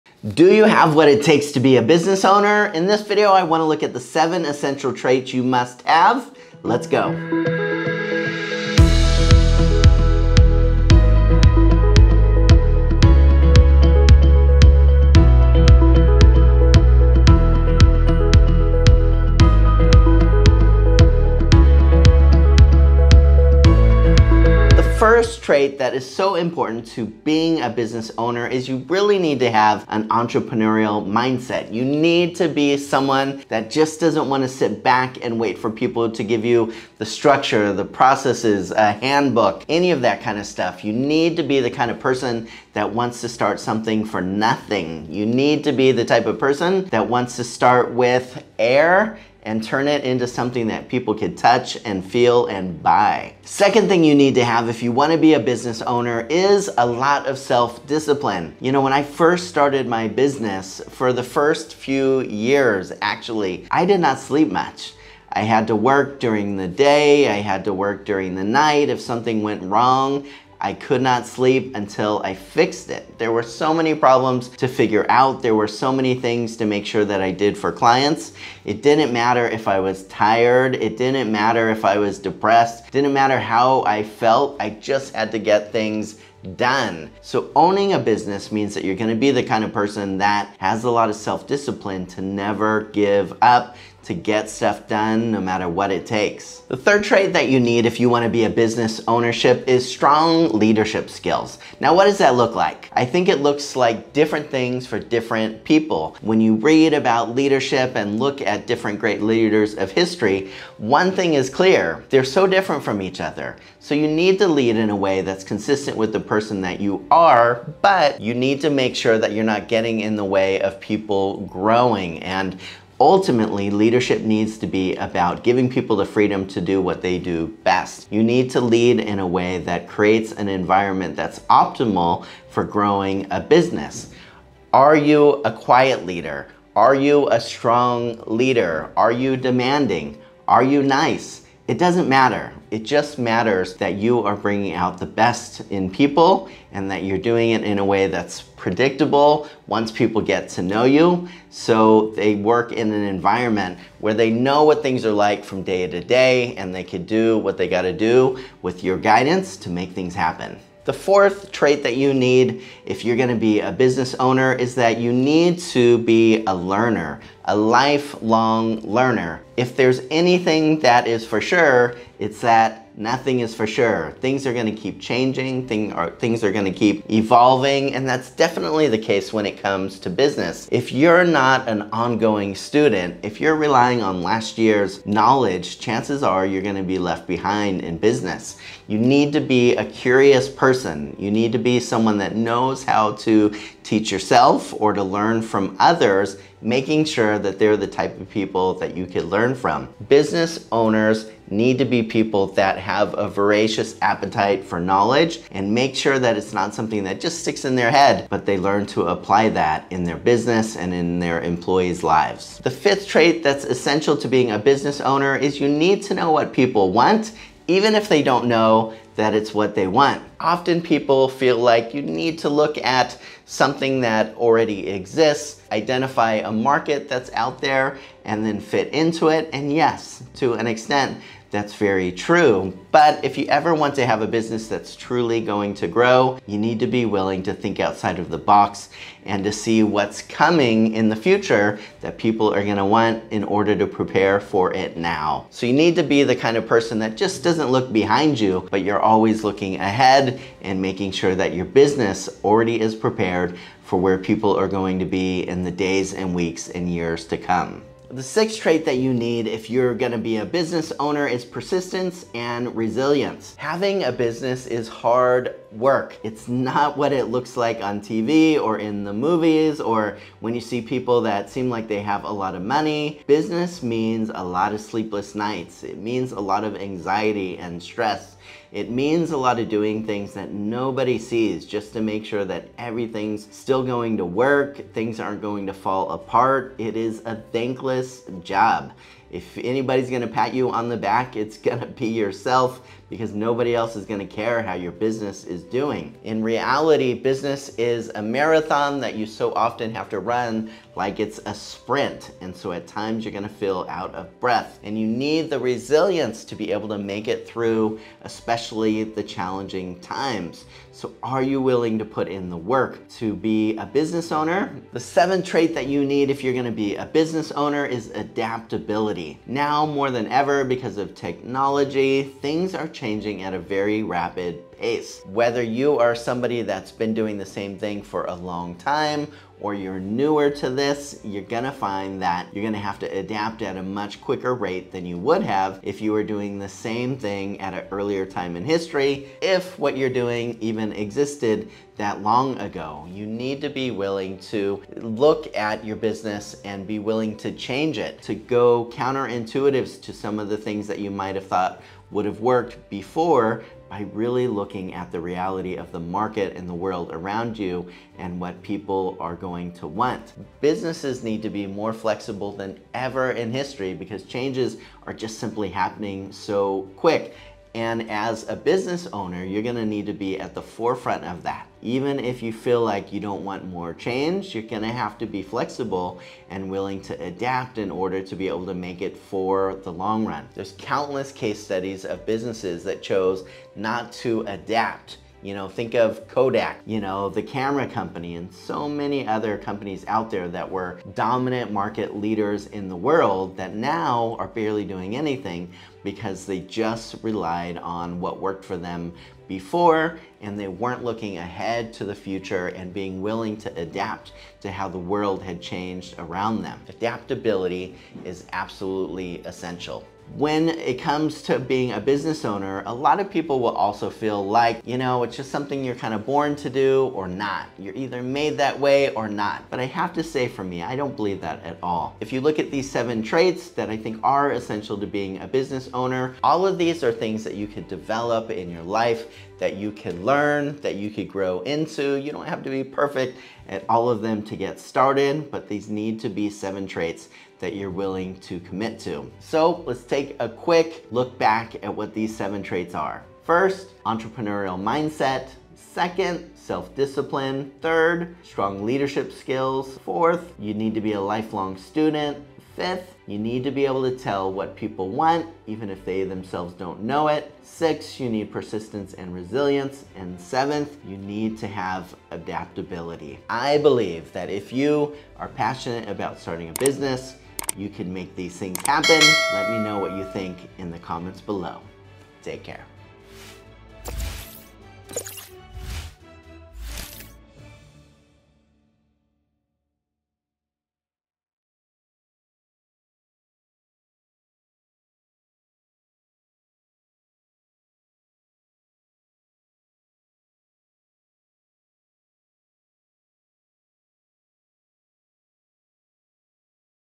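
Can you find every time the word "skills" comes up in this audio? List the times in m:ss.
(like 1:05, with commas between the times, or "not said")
1:41, 7:29.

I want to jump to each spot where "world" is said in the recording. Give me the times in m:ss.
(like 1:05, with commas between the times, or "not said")
5:56, 6:32, 6:44.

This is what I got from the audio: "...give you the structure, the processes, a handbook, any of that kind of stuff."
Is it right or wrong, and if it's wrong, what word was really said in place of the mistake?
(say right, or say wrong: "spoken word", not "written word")
right.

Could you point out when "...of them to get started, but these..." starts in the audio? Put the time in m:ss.
7:14.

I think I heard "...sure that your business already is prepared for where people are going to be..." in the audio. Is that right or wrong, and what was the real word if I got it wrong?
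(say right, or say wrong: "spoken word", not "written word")
right.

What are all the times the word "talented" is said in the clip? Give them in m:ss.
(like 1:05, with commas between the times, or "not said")
not said.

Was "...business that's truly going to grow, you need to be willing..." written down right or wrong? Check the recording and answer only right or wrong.
right.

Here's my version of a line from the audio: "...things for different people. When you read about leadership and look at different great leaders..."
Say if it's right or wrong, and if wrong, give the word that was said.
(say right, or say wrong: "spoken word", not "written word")
right.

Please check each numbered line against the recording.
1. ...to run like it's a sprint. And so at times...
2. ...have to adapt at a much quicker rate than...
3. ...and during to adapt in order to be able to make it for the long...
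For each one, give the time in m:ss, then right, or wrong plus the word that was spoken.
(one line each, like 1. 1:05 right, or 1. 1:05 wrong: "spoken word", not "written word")
1. 5:00 right
2. 5:32 right
3. 6:16 wrong: "willing", not "during".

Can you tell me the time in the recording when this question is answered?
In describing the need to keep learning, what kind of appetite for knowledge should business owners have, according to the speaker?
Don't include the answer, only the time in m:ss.
3:23.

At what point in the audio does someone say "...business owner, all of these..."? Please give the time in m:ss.
7:05.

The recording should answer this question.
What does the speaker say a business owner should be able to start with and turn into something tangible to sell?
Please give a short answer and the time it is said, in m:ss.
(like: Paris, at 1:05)
Air, at 0:48.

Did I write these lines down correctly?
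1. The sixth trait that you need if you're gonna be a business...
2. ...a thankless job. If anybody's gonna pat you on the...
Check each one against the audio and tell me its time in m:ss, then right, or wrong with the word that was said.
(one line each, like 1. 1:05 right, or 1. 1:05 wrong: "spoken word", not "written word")
1. 4:18 right
2. 4:47 right.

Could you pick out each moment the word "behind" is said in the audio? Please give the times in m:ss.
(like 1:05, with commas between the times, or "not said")
3:07, 4:07.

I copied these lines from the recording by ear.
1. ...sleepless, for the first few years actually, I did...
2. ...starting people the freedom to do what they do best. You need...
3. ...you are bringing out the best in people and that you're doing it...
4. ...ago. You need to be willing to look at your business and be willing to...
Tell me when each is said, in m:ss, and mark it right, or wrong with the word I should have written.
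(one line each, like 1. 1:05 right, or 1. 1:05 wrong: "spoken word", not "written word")
1. 1:00 wrong: "business", not "sleepless"
2. 2:05 wrong: "giving", not "starting"
3. 2:23 right
4. 5:42 right.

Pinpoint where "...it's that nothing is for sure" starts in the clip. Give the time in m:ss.
2:52.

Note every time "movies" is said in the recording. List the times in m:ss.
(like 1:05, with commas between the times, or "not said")
4:29.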